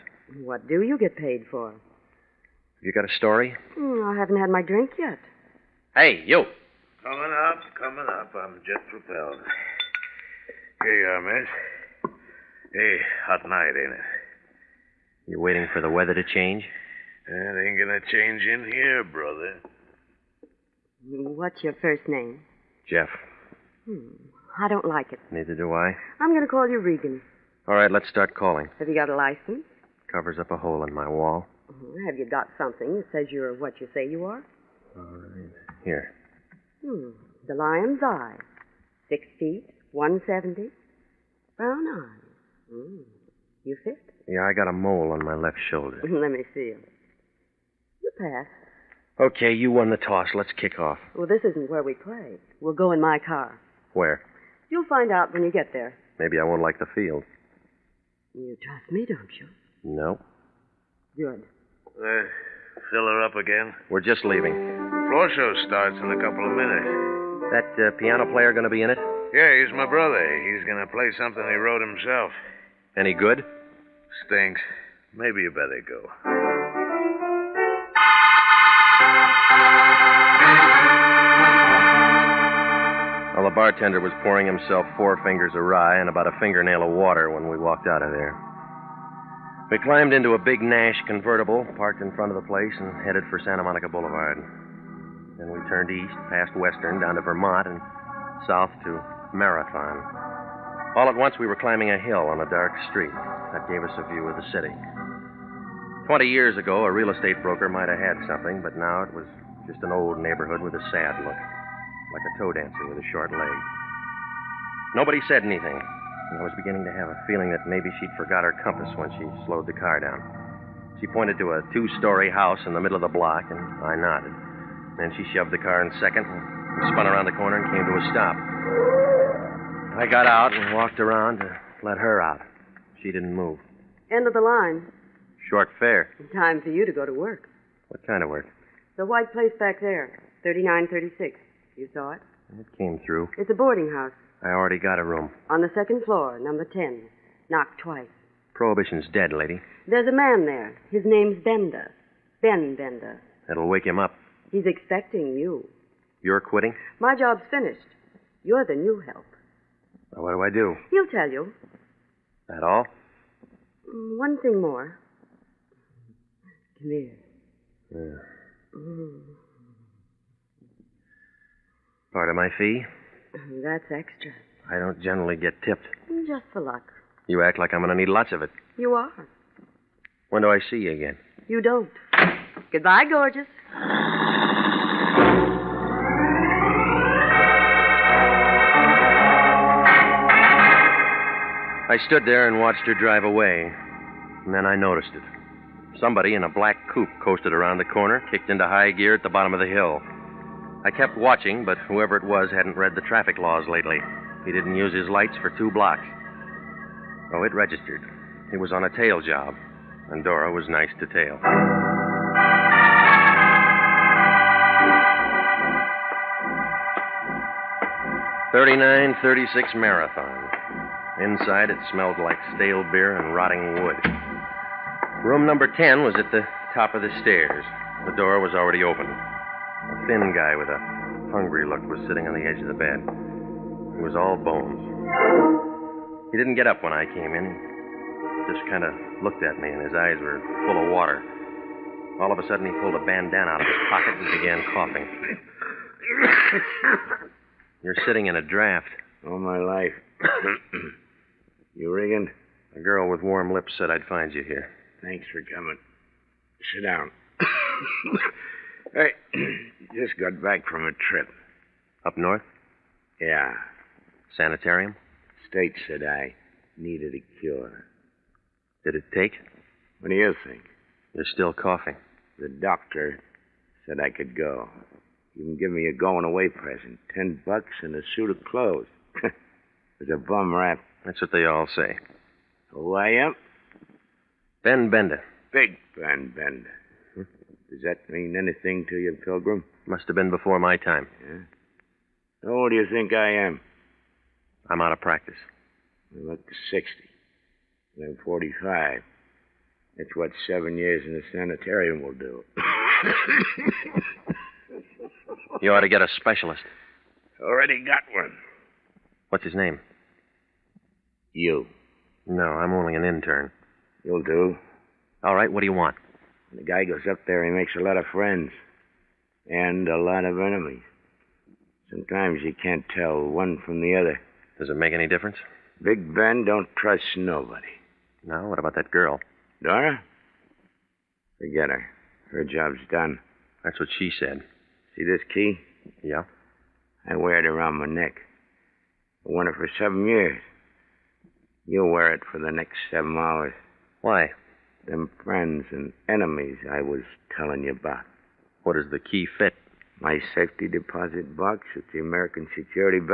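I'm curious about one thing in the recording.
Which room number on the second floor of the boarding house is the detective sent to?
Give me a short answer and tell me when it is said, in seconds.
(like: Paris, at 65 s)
10, at 146 s.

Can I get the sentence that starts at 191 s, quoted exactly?
I stood there and watched her drive away.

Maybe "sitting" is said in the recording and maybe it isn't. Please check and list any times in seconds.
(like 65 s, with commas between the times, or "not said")
232 s, 248 s.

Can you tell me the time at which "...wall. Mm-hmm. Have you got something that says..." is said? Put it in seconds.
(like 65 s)
31 s.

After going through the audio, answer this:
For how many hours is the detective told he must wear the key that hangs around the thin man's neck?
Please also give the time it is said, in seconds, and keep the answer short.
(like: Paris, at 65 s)
7, at 342 s.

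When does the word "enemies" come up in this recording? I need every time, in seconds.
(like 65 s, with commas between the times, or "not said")
320 s, 346 s.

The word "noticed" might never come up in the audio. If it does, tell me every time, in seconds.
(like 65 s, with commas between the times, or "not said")
194 s.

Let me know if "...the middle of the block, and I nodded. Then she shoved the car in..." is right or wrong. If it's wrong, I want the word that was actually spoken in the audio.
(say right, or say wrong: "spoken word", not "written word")
right.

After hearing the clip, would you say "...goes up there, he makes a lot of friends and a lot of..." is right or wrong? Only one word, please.
right.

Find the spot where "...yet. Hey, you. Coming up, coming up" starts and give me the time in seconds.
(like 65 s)
4 s.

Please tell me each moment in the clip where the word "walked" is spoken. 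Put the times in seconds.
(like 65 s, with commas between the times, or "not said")
87 s, 130 s.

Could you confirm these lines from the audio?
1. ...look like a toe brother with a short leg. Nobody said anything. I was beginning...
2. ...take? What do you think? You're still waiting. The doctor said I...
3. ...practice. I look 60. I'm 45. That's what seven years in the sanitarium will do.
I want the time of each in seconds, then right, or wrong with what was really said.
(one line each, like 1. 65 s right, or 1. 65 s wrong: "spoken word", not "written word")
1. 111 s wrong: "dancer", not "brother"
2. 269 s wrong: "coughing", not "waiting"
3. 295 s right.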